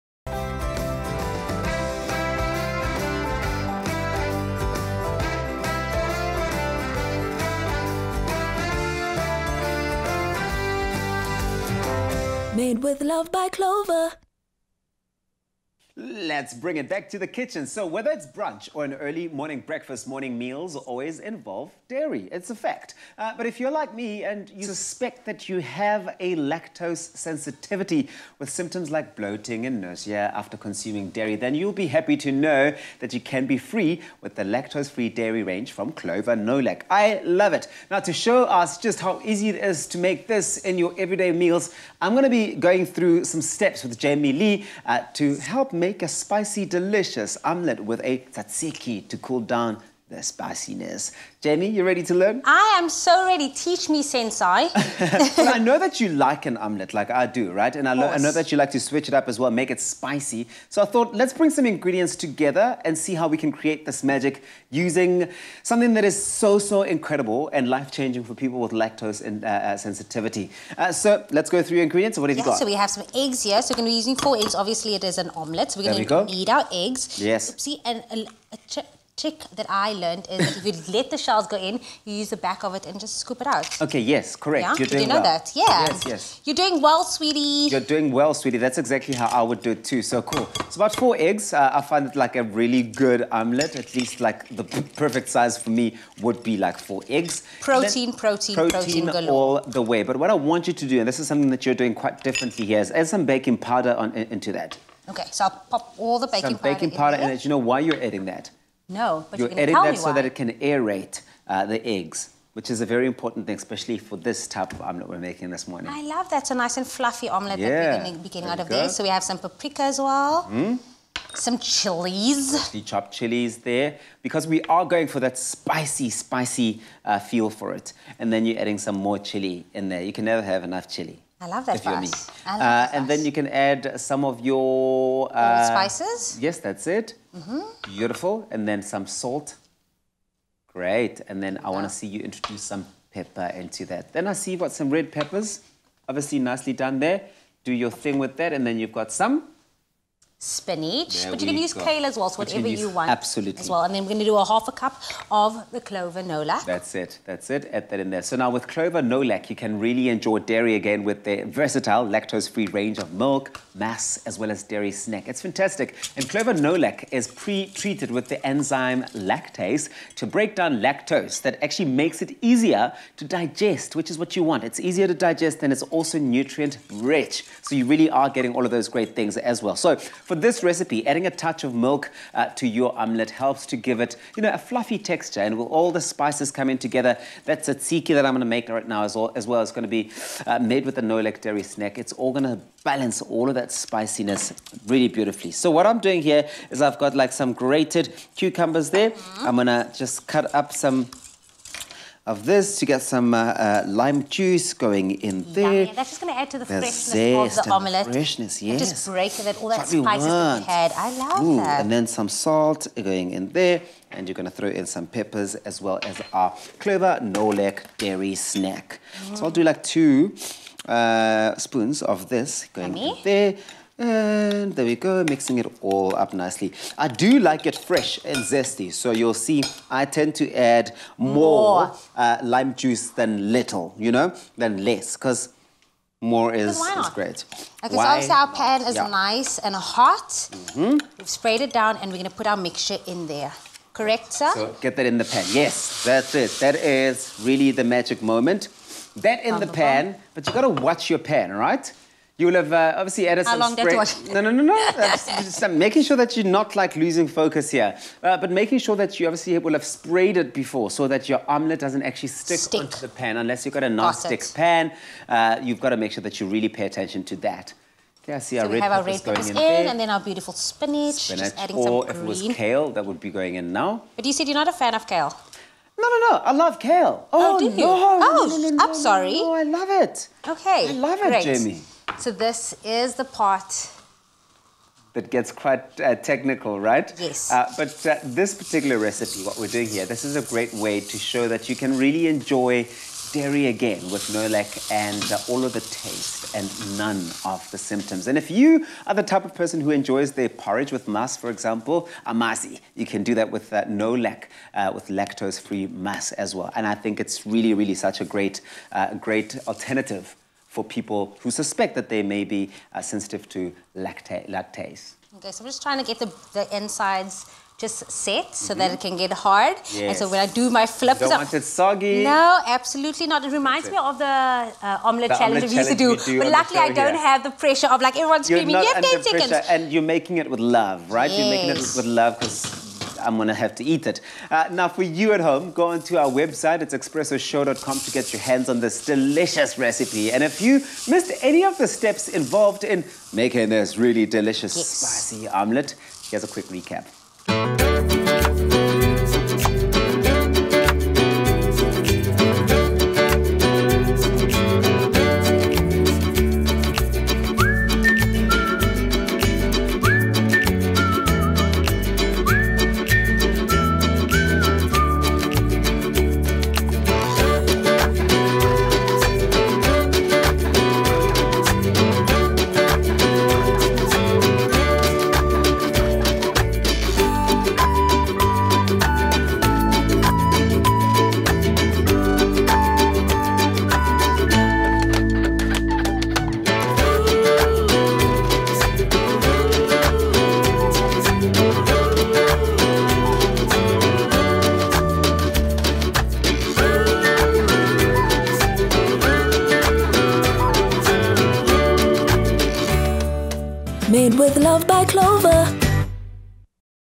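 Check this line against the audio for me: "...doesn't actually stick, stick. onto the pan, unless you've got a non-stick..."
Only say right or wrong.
right.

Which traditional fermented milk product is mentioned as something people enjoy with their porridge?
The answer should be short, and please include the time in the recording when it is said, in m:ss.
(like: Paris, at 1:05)
Amasi, at 5:02.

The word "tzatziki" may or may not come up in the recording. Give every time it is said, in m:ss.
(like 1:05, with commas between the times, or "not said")
0:48, 3:07.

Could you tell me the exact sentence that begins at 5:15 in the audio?
Okay, so I'm just trying to get the, the insides just set so mm -hmm.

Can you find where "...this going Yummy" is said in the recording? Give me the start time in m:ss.
3:42.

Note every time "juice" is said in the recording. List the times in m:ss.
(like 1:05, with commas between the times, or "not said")
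3:24, 3:52.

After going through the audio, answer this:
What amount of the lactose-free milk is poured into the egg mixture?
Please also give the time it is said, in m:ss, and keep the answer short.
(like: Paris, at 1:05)
Half a cup, at 2:34.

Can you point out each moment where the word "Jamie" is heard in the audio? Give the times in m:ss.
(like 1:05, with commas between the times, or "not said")
0:43, 0:51, 4:41.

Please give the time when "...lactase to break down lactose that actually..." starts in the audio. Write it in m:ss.
2:49.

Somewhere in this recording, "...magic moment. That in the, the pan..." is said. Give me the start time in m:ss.
4:07.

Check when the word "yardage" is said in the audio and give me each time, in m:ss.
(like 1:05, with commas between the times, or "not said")
not said.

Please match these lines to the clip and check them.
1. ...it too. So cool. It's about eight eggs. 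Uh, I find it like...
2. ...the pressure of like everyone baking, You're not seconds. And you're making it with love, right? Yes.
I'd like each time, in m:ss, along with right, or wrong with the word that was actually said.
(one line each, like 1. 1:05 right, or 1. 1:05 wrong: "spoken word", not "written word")
1. 1:29 wrong: "four", not "eight"
2. 5:27 wrong: "screaming", not "baking".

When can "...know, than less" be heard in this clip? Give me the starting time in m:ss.
3:54.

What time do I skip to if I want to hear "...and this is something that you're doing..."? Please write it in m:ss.
1:40.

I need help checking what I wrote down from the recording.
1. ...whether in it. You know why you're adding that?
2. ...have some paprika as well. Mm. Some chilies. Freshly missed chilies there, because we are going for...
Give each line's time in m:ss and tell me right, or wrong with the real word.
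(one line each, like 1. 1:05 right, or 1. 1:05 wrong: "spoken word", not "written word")
1. 1:47 wrong: "powder", not "whether"
2. 1:59 wrong: "chopped", not "missed".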